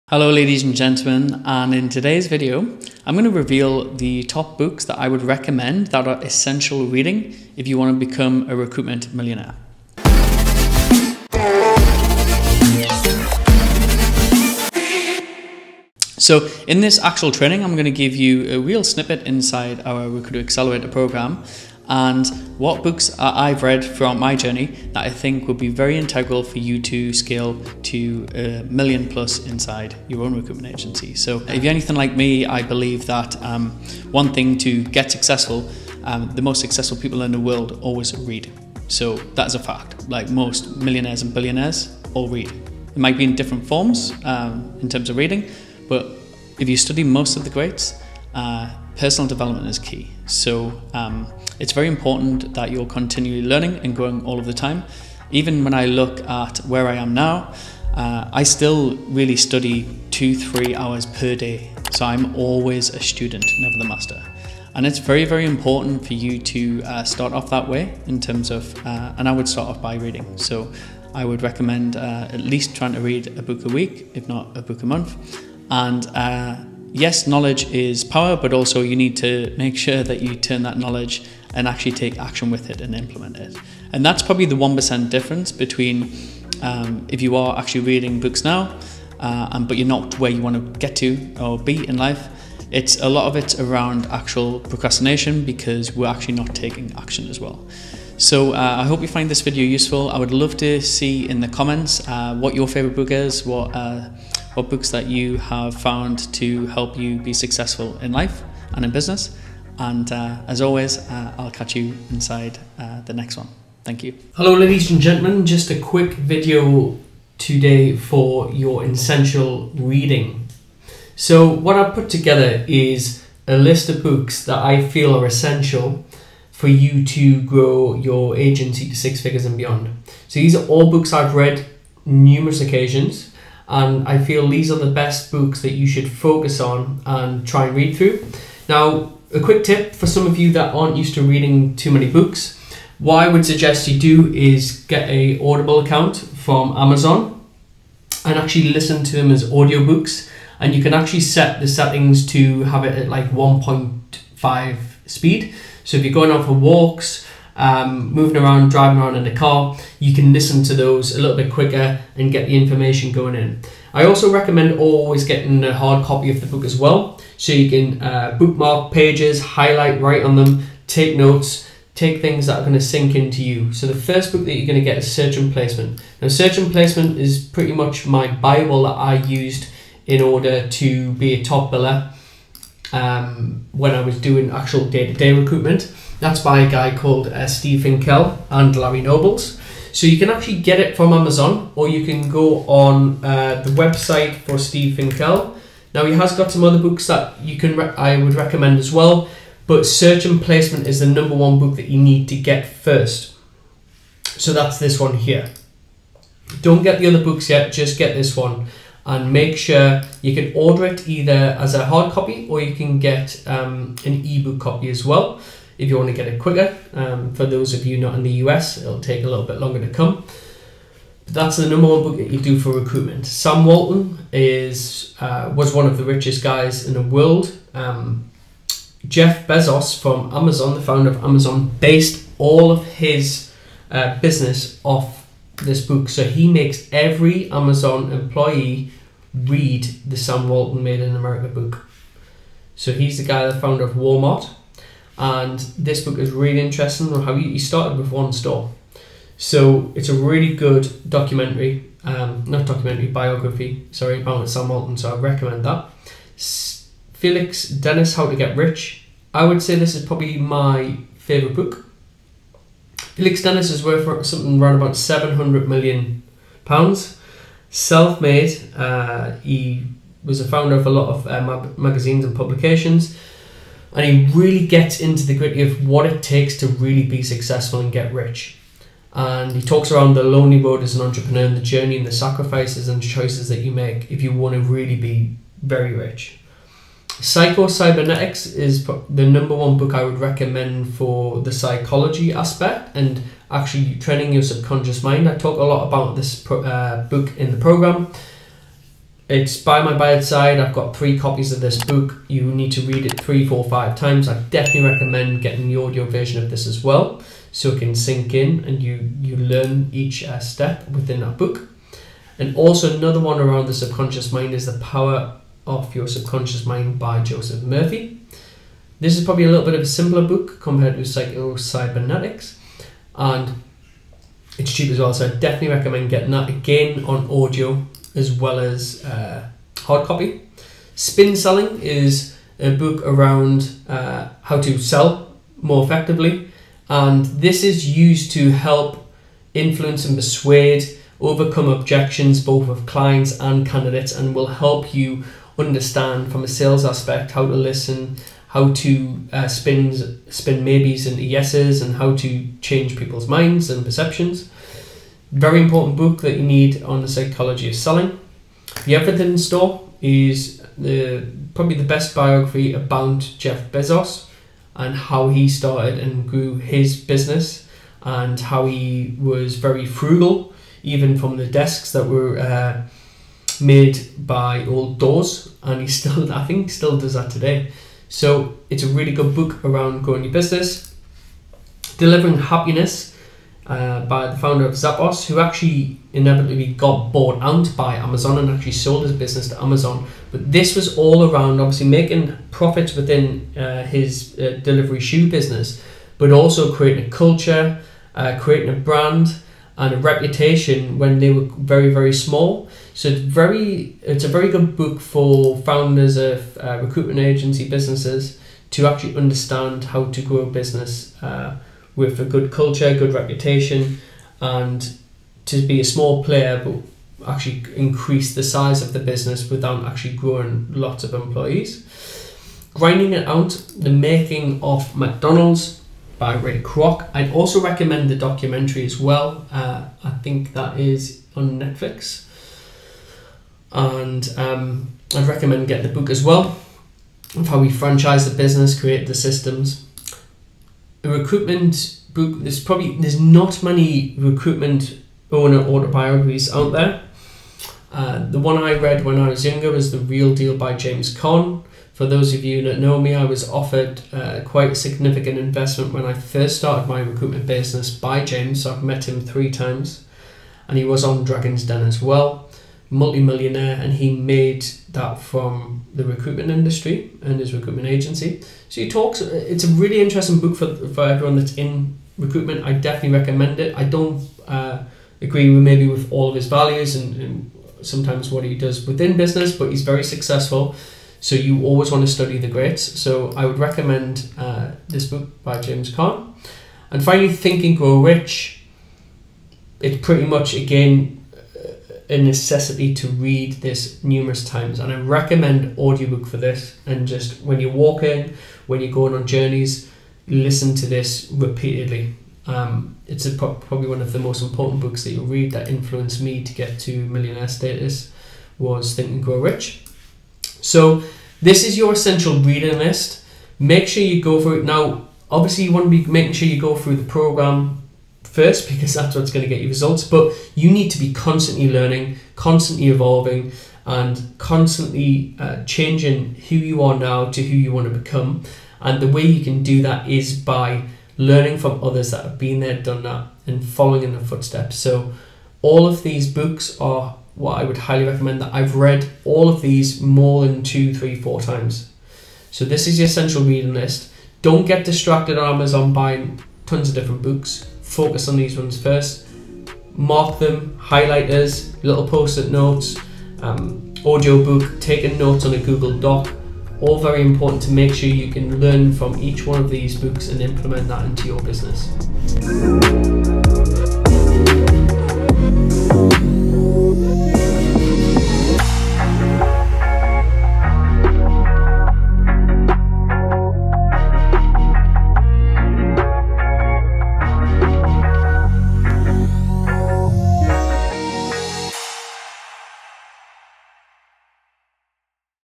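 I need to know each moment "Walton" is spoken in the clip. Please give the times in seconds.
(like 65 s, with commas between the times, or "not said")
223 s, 240 s, 254 s.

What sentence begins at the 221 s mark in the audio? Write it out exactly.
But that's the number one book that you do for recruitment.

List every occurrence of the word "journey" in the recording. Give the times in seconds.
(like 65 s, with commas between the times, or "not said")
24 s, 281 s, 499 s.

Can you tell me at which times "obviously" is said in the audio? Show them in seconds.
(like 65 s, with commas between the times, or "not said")
391 s, 515 s.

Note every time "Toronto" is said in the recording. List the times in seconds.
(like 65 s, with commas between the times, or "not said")
not said.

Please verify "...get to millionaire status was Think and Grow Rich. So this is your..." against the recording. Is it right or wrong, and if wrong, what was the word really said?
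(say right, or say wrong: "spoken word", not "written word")
right.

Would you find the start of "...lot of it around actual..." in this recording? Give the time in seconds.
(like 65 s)
93 s.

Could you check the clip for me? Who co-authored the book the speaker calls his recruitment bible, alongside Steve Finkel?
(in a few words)
Larry Nobles.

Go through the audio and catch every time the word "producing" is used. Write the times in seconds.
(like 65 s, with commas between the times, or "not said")
not said.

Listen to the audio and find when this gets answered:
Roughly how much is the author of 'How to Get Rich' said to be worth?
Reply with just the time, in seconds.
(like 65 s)
264 s.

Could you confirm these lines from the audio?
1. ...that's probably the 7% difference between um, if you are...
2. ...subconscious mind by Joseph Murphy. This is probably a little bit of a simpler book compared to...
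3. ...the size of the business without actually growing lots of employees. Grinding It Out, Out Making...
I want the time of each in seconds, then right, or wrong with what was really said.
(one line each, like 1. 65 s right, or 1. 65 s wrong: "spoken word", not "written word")
1. 84 s wrong: "1", not "7"
2. 316 s right
3. 418 s wrong: "The", not "Out".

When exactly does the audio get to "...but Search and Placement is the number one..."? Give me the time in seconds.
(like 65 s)
199 s.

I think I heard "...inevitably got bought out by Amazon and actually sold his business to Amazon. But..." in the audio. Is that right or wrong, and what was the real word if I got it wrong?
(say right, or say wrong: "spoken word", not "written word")
right.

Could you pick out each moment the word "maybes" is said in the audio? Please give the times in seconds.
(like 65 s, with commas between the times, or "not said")
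350 s, 475 s.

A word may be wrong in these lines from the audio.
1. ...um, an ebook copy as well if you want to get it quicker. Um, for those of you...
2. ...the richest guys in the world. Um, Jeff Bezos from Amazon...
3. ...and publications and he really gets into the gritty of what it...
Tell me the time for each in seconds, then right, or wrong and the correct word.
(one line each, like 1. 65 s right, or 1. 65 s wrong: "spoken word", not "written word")
1. 213 s right
2. 225 s right
3. 272 s right.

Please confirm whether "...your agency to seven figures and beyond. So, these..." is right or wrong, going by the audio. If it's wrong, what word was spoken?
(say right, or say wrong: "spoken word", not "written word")
wrong: "six", not "seven".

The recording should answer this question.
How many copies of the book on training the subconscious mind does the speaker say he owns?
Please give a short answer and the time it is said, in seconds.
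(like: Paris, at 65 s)
3, at 300 s.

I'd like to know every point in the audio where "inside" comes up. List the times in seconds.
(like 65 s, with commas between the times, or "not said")
19 s, 29 s, 112 s.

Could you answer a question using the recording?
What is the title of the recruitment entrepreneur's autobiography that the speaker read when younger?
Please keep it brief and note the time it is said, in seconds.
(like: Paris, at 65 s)
The Real Deal, at 449 s.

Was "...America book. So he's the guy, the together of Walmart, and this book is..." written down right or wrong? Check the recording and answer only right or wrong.
wrong.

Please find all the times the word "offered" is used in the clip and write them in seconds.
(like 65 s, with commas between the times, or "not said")
453 s.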